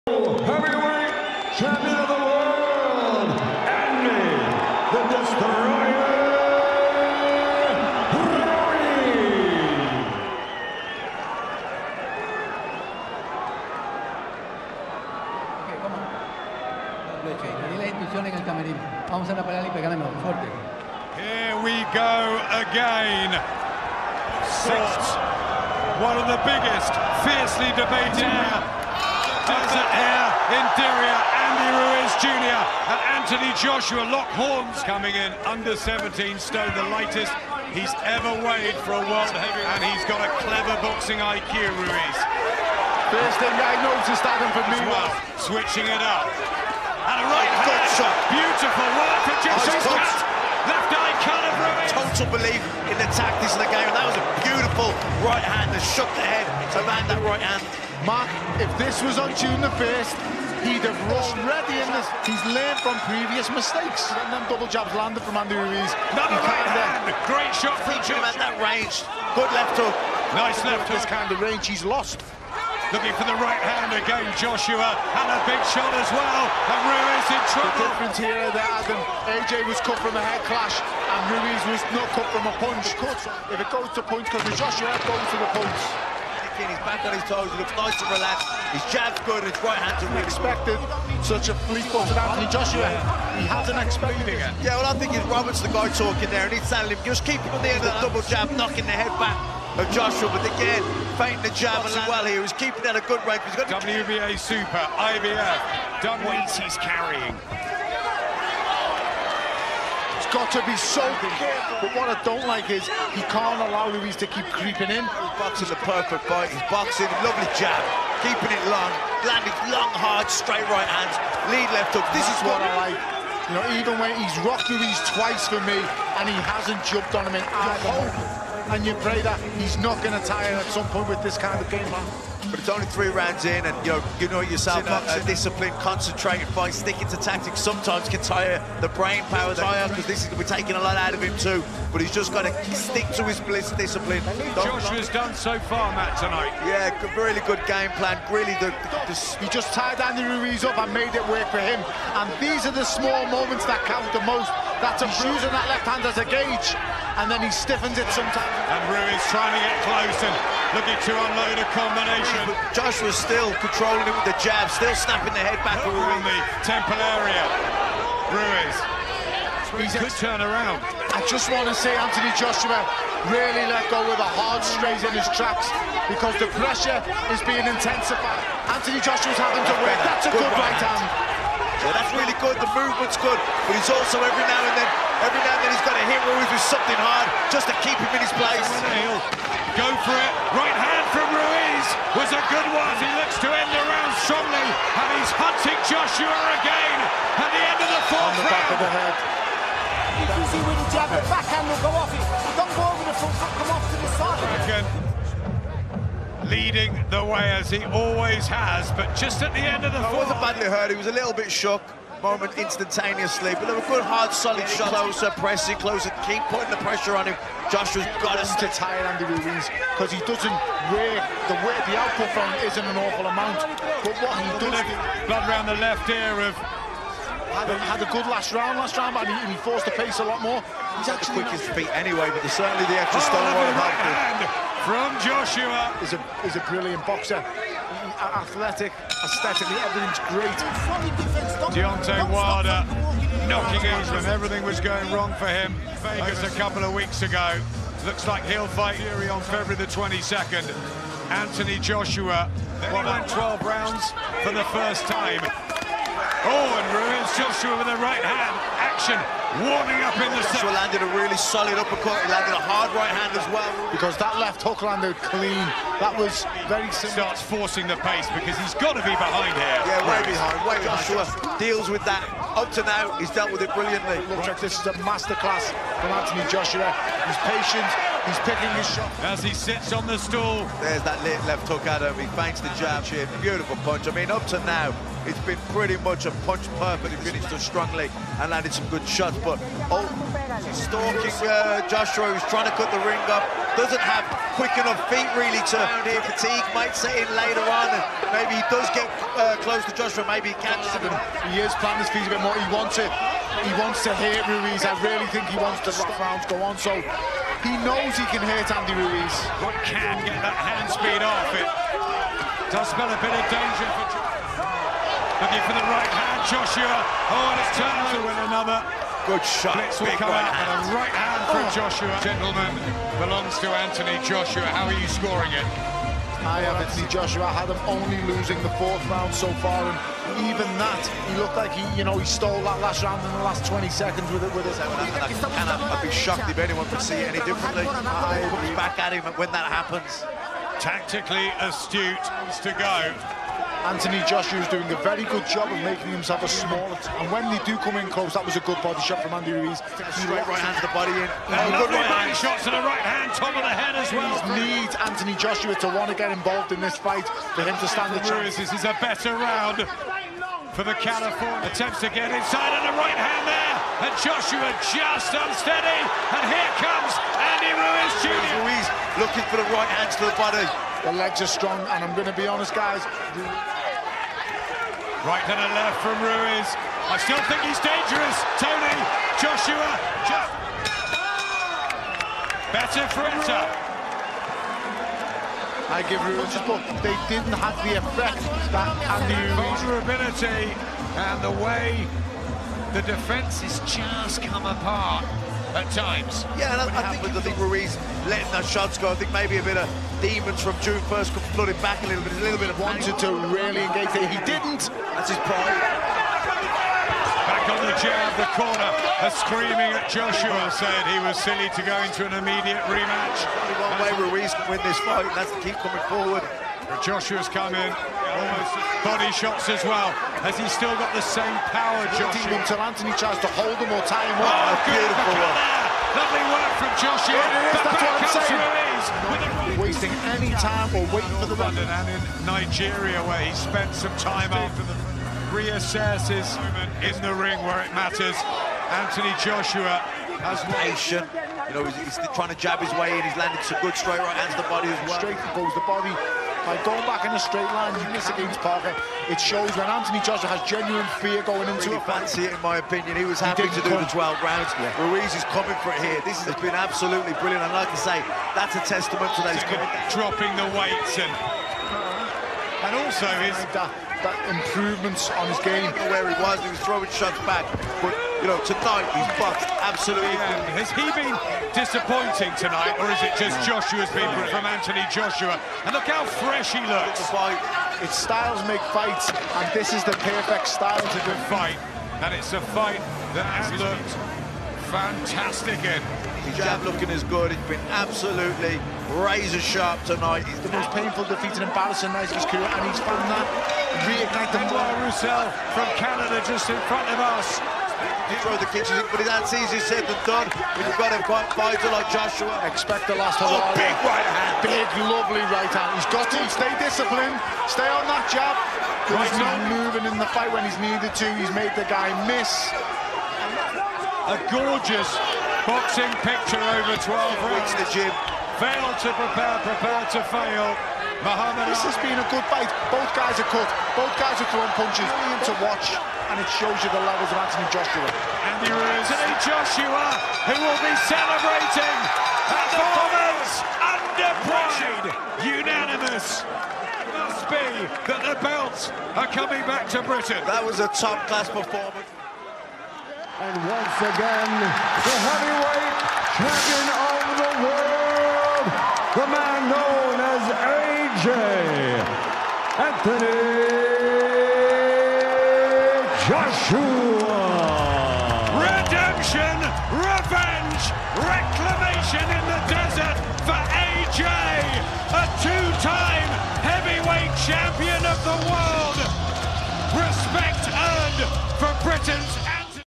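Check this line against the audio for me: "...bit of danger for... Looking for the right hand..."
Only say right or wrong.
right.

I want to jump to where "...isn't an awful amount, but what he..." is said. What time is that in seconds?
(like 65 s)
222 s.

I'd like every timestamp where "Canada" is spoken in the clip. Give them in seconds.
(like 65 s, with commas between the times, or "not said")
495 s.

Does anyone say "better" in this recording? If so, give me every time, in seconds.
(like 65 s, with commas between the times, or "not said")
359 s, 382 s.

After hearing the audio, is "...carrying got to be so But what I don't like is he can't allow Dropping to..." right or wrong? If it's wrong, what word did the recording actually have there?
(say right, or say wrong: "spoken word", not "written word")
wrong: "Ruiz", not "Dropping".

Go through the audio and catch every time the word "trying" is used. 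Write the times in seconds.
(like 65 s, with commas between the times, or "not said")
159 s, 292 s, 442 s.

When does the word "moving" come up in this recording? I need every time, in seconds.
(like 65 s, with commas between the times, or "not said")
509 s.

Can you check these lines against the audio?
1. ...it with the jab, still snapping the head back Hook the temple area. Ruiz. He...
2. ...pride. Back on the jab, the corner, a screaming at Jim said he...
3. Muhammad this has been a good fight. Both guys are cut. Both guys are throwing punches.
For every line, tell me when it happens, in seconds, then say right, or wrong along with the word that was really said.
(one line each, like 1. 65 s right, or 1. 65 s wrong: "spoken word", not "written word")
1. 164 s right
2. 405 s wrong: "Joshua", not "Jim"
3. 521 s right.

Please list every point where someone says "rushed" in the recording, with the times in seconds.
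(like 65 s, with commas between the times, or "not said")
61 s.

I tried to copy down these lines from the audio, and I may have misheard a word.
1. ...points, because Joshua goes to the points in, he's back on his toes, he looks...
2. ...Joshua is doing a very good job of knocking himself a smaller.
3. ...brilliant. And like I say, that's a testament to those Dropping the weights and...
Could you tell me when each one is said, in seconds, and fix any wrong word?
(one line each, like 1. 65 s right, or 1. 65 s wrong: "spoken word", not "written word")
1. 84 s right
2. 344 s wrong: "making", not "knocking"
3. 457 s right.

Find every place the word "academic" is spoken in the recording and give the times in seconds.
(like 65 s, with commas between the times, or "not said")
not said.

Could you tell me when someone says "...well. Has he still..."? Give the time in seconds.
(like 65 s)
419 s.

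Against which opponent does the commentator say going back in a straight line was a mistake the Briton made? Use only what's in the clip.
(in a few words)
Parker.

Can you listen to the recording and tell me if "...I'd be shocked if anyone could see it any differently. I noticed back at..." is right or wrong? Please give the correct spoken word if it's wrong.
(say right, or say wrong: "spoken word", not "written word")
wrong: "looked", not "noticed".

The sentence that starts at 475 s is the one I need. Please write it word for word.
And look how fresh he looks.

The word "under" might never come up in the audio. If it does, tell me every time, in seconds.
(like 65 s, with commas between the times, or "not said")
35 s, 533 s.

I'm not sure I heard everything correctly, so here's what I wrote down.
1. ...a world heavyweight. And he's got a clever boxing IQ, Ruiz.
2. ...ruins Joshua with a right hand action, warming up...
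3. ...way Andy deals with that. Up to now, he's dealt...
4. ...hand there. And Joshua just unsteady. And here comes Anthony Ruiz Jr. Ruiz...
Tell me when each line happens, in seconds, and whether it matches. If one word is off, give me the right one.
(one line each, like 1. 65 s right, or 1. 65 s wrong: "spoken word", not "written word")
1. 39 s right
2. 256 s right
3. 270 s wrong: "Joshua", not "Andy"
4. 363 s wrong: "Andy", not "Anthony".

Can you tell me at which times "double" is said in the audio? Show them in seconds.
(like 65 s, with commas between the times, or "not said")
64 s, 98 s.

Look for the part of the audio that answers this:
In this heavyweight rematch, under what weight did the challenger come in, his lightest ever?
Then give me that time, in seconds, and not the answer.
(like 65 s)
35 s.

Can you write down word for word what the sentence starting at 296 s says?
Fatigue might set in later on, and maybe he does get uh, close to Joshua, maybe he catches him.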